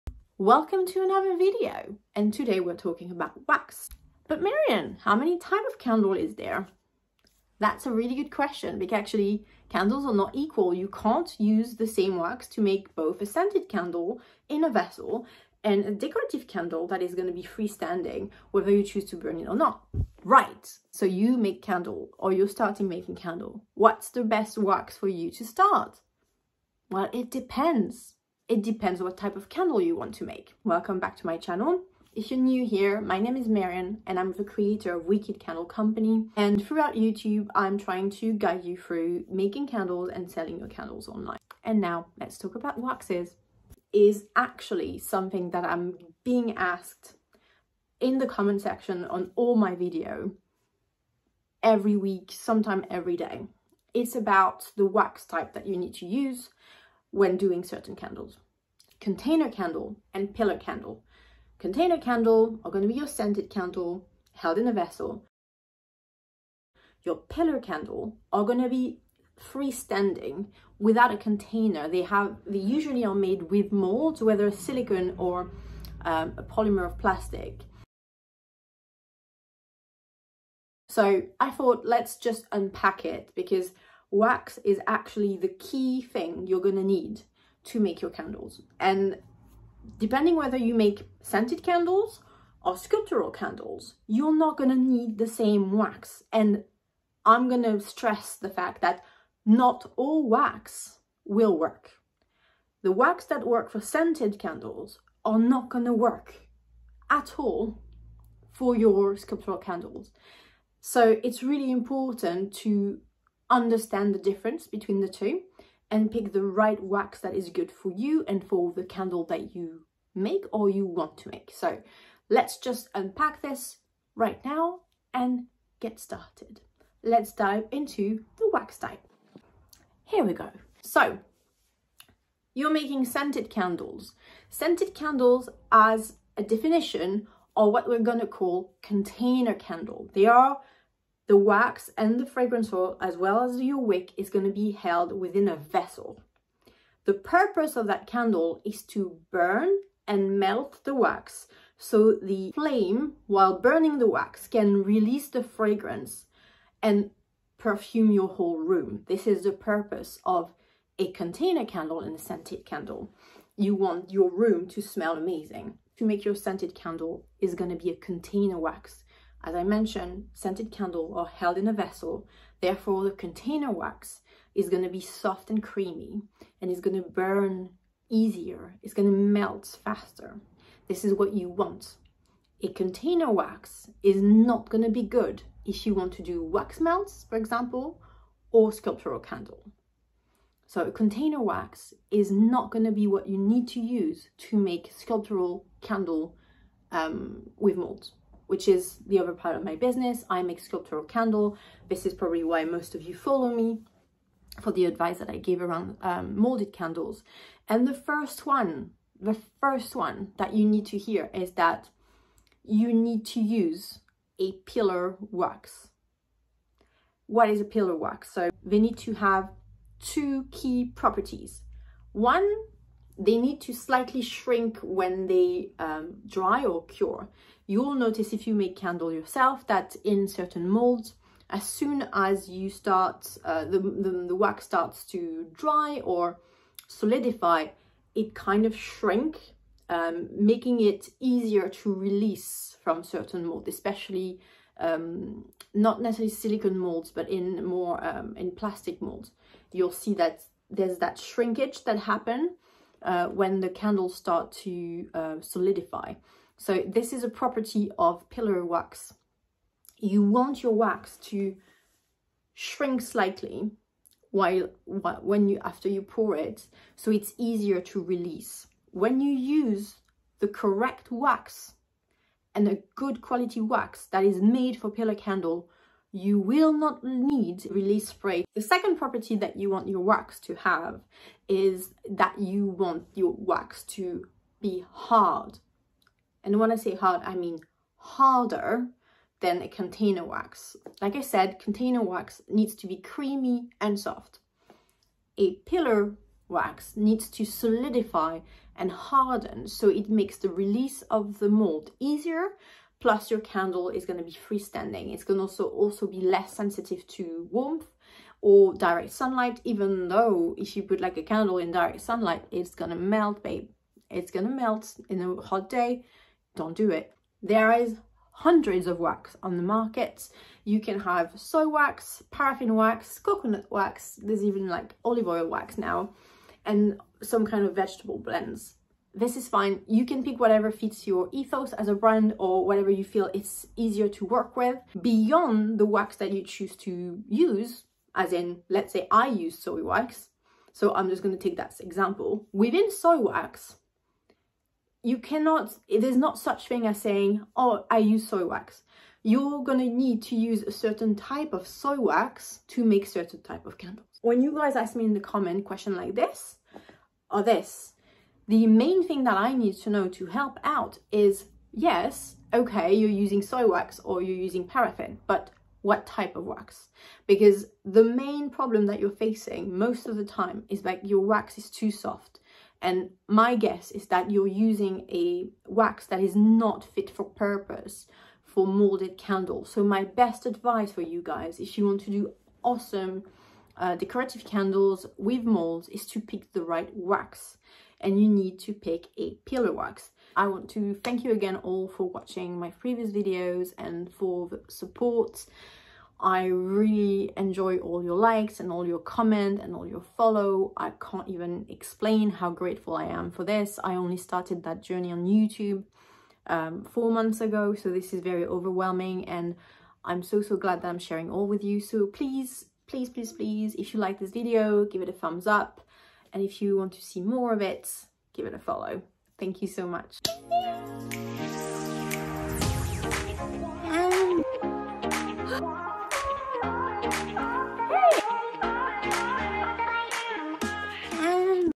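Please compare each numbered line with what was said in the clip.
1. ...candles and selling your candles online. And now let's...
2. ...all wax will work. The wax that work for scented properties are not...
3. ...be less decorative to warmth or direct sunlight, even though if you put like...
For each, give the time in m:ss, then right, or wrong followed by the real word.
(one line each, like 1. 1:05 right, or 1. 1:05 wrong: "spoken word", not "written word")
1. 0:39 right
2. 1:39 wrong: "candles", not "properties"
3. 5:06 wrong: "sensitive", not "decorative".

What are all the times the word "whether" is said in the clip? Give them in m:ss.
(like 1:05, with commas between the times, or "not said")
0:18, 1:14, 1:30.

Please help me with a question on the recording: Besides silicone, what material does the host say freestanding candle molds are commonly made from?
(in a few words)
a polymer of plastic.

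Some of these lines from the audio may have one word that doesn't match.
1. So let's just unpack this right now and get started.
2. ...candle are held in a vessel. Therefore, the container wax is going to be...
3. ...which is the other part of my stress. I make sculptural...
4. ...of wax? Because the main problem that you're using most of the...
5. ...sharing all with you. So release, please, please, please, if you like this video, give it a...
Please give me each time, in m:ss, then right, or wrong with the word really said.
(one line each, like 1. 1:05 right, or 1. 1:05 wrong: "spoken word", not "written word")
1. 2:01 right
2. 2:50 right
3. 3:18 wrong: "business", not "stress"
4. 6:06 wrong: "facing", not "using"
5. 6:50 wrong: "please", not "release".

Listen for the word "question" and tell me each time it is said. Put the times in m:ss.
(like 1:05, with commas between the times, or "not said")
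0:08, 5:55.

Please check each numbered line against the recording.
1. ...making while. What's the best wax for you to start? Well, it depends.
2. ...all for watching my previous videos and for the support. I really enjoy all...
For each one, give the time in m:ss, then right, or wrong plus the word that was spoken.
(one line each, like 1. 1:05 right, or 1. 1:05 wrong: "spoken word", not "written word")
1. 0:22 wrong: "candle", not "while"
2. 6:31 right.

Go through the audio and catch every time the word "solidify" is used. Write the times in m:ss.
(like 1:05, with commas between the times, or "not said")
3:56, 4:15, 4:57.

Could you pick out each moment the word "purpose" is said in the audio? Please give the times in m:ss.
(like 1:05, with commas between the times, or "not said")
2:27, 2:39, 6:17.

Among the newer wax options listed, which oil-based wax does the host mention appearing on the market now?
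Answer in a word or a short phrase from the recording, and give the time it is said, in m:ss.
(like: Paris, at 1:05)
olive oil wax, at 5:25.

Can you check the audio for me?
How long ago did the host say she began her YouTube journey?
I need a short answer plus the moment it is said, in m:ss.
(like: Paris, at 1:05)
4 months, at 6:46.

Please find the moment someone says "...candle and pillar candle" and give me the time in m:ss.
0:59.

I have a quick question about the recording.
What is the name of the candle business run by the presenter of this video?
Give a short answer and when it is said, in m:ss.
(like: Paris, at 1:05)
Wicked Candle Company, at 0:35.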